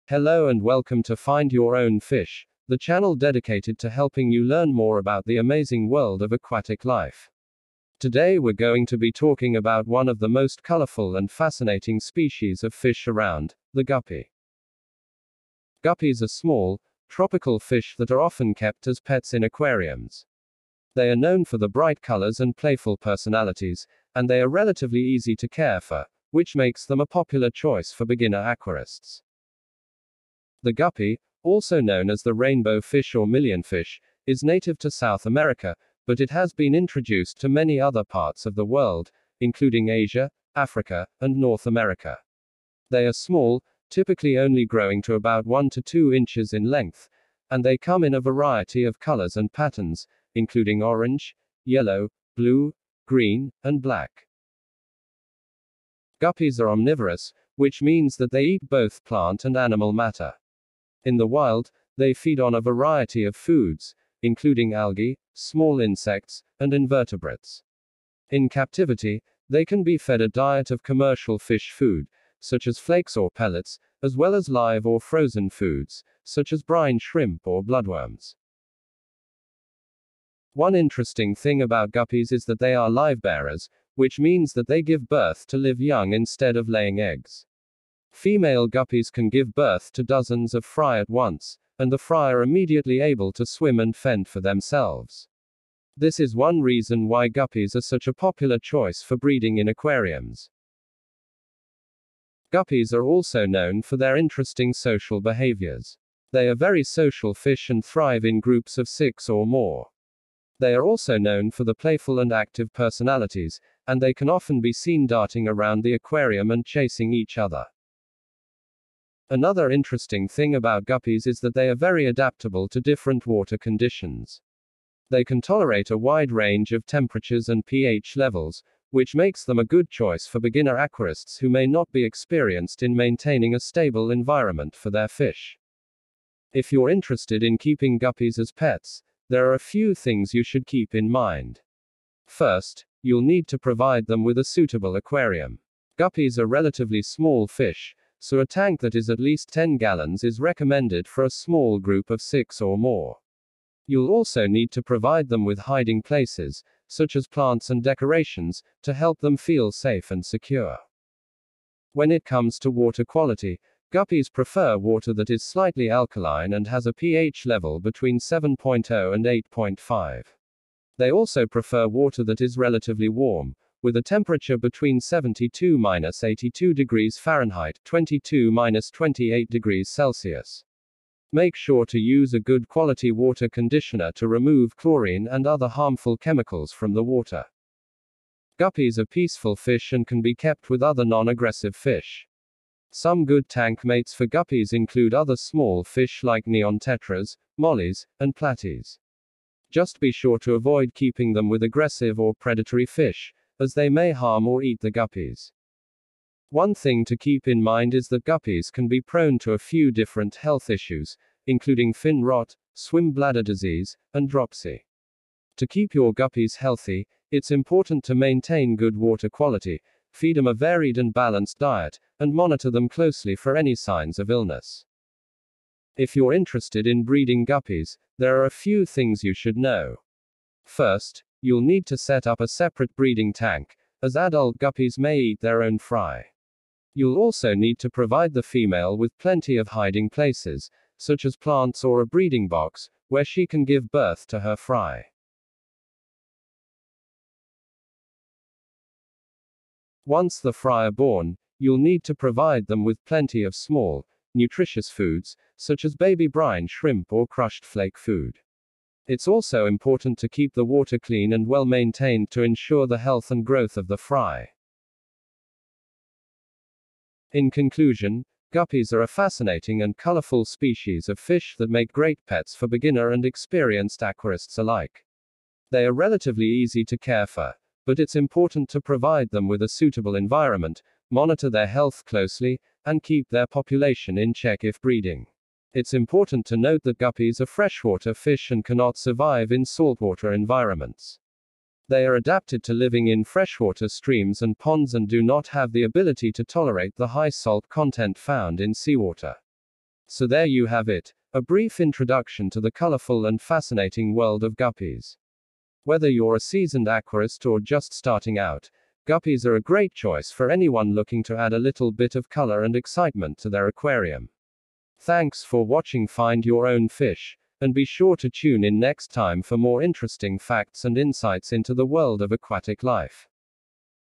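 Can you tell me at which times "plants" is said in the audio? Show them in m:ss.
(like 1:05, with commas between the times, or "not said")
0:59, 2:37, 4:01.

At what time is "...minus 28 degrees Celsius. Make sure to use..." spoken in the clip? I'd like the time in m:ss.
2:58.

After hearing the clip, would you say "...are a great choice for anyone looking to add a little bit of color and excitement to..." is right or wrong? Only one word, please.
right.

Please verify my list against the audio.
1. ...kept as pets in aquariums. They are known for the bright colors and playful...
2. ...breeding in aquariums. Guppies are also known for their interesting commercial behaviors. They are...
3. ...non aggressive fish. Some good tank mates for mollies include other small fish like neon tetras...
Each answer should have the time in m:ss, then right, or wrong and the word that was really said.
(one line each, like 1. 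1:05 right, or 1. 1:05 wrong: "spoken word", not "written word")
1. 0:18 right
2. 1:39 wrong: "social", not "commercial"
3. 3:11 wrong: "guppies", not "mollies".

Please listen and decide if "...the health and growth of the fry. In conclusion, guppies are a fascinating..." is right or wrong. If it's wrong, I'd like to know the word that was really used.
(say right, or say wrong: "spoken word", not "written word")
right.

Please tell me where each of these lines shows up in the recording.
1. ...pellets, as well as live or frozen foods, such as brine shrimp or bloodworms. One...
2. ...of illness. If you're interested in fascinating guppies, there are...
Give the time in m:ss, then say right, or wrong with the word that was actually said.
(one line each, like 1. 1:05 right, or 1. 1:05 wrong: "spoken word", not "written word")
1. 1:13 right
2. 3:44 wrong: "breeding", not "fascinating".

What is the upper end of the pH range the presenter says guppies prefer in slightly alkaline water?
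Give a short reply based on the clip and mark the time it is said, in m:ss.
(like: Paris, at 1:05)
8.5, at 2:49.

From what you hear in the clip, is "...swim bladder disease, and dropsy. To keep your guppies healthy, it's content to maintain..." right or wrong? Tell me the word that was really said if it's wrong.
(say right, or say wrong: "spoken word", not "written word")
wrong: "important", not "content".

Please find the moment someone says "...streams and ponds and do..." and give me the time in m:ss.
4:53.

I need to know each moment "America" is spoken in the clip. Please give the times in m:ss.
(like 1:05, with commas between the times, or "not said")
0:35, 0:41.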